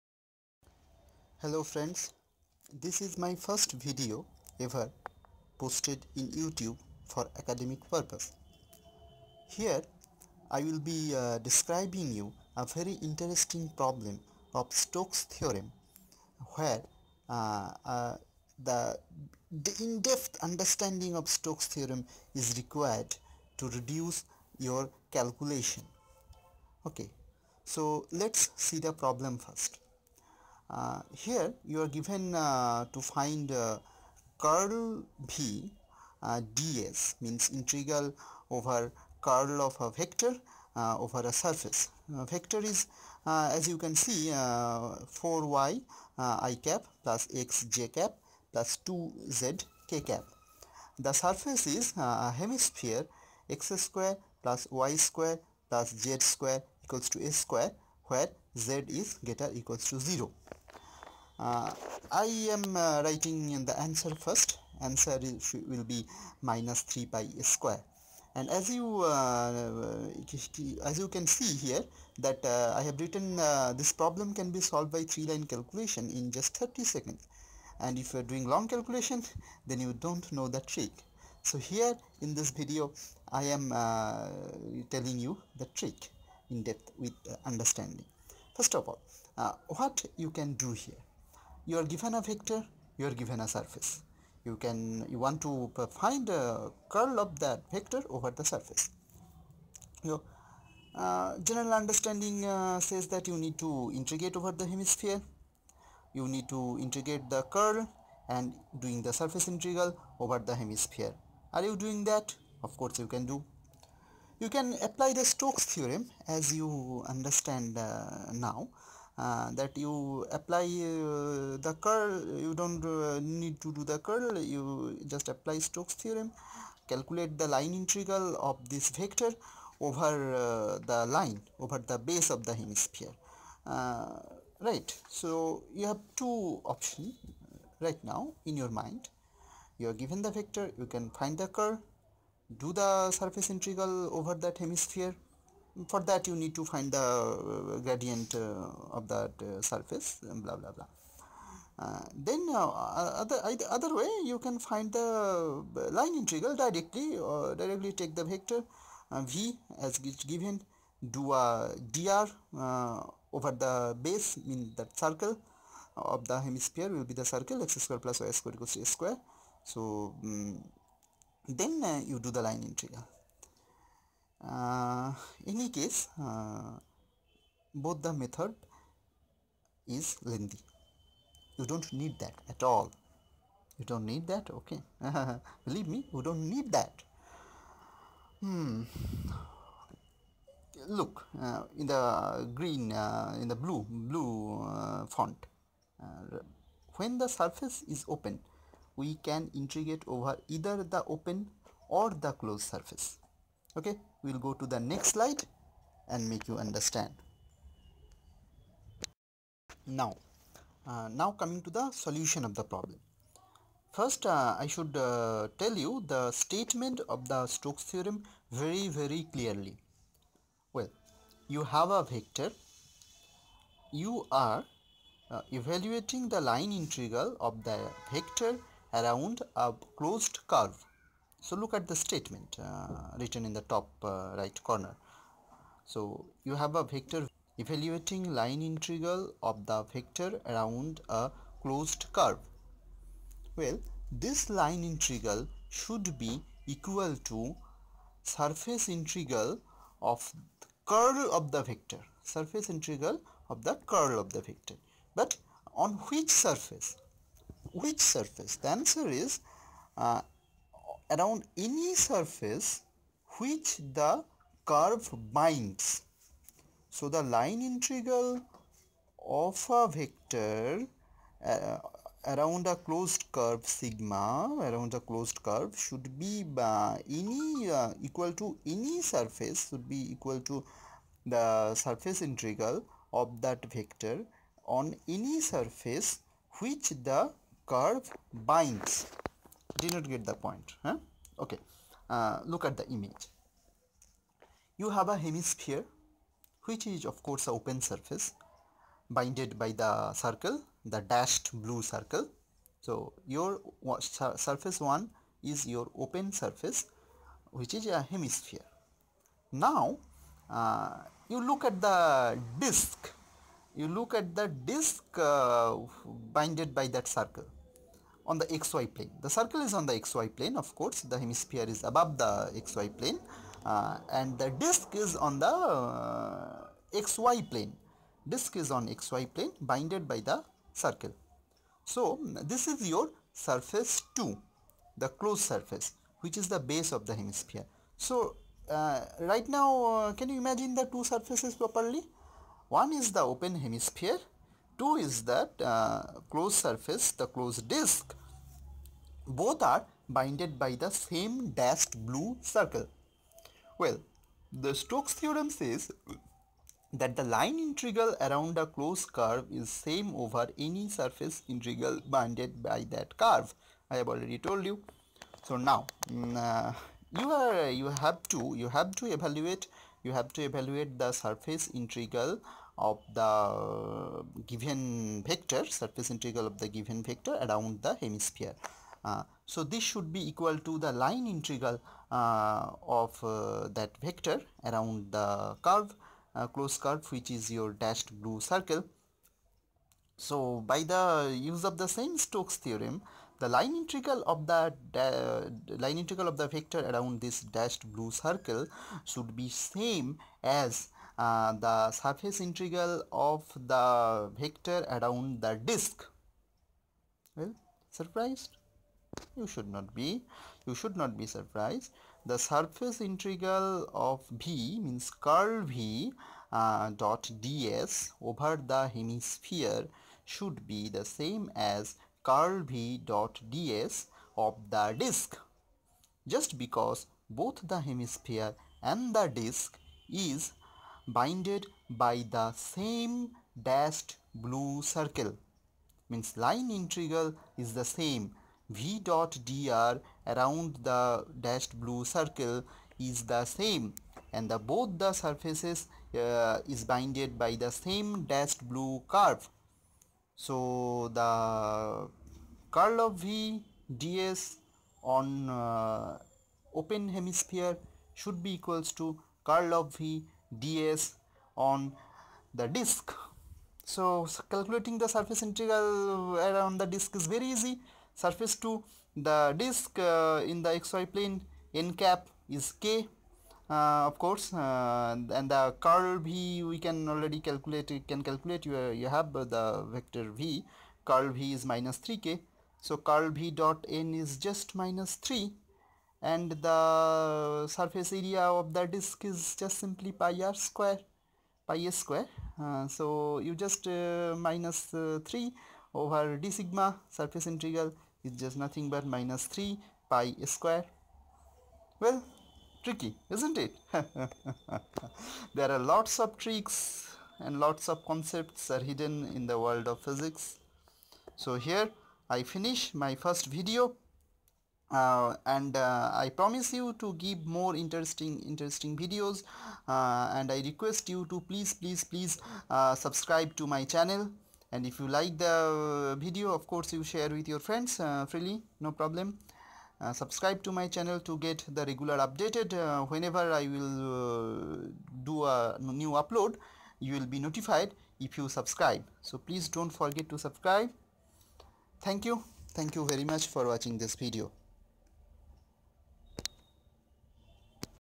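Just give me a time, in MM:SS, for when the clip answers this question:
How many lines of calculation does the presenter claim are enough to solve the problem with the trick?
01:15.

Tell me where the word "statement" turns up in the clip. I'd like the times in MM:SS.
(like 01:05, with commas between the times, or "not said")
03:36, 03:51.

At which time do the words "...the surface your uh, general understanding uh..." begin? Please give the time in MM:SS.
01:38.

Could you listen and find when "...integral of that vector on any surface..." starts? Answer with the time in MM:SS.
04:42.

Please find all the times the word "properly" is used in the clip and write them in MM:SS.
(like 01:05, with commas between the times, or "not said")
05:41.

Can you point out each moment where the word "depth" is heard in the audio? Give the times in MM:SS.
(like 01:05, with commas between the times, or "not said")
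00:19, 01:26.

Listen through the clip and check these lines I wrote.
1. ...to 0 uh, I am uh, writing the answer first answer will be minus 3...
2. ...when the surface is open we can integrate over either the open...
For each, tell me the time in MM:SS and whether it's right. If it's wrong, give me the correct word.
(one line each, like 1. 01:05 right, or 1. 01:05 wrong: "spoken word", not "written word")
1. 00:59 right
2. 03:16 right.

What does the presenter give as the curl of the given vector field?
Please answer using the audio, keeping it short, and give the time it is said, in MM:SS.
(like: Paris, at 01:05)
minus 3k, at 08:01.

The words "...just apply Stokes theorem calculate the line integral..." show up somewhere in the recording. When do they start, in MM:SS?
02:05.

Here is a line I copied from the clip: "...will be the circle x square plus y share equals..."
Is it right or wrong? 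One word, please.
wrong.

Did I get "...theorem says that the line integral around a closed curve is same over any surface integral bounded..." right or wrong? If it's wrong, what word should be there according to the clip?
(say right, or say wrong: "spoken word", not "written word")
right.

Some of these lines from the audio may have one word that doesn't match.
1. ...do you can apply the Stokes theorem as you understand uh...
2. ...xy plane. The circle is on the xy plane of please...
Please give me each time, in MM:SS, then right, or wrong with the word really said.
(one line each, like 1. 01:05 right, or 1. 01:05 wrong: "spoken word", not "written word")
1. 01:53 right
2. 05:18 wrong: "course", not "please".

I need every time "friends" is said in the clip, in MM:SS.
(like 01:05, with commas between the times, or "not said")
00:01, 08:47.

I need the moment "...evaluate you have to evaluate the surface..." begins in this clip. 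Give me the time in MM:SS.
06:09.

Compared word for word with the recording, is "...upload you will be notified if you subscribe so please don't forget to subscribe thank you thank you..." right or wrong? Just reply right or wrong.
right.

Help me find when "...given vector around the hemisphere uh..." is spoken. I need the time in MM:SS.
06:16.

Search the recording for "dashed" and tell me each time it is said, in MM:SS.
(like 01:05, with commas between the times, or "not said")
05:01, 05:51, 06:27, 06:37, 07:13, 07:21, 07:28.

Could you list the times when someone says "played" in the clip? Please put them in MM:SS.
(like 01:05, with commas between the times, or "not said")
not said.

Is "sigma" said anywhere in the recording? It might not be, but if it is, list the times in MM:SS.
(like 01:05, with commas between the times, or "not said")
04:33, 08:16.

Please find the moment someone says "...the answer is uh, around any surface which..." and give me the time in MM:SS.
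04:18.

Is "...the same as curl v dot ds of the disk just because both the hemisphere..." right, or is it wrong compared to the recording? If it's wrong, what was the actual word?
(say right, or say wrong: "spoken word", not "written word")
right.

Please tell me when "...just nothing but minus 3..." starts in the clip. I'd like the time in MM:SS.
08:18.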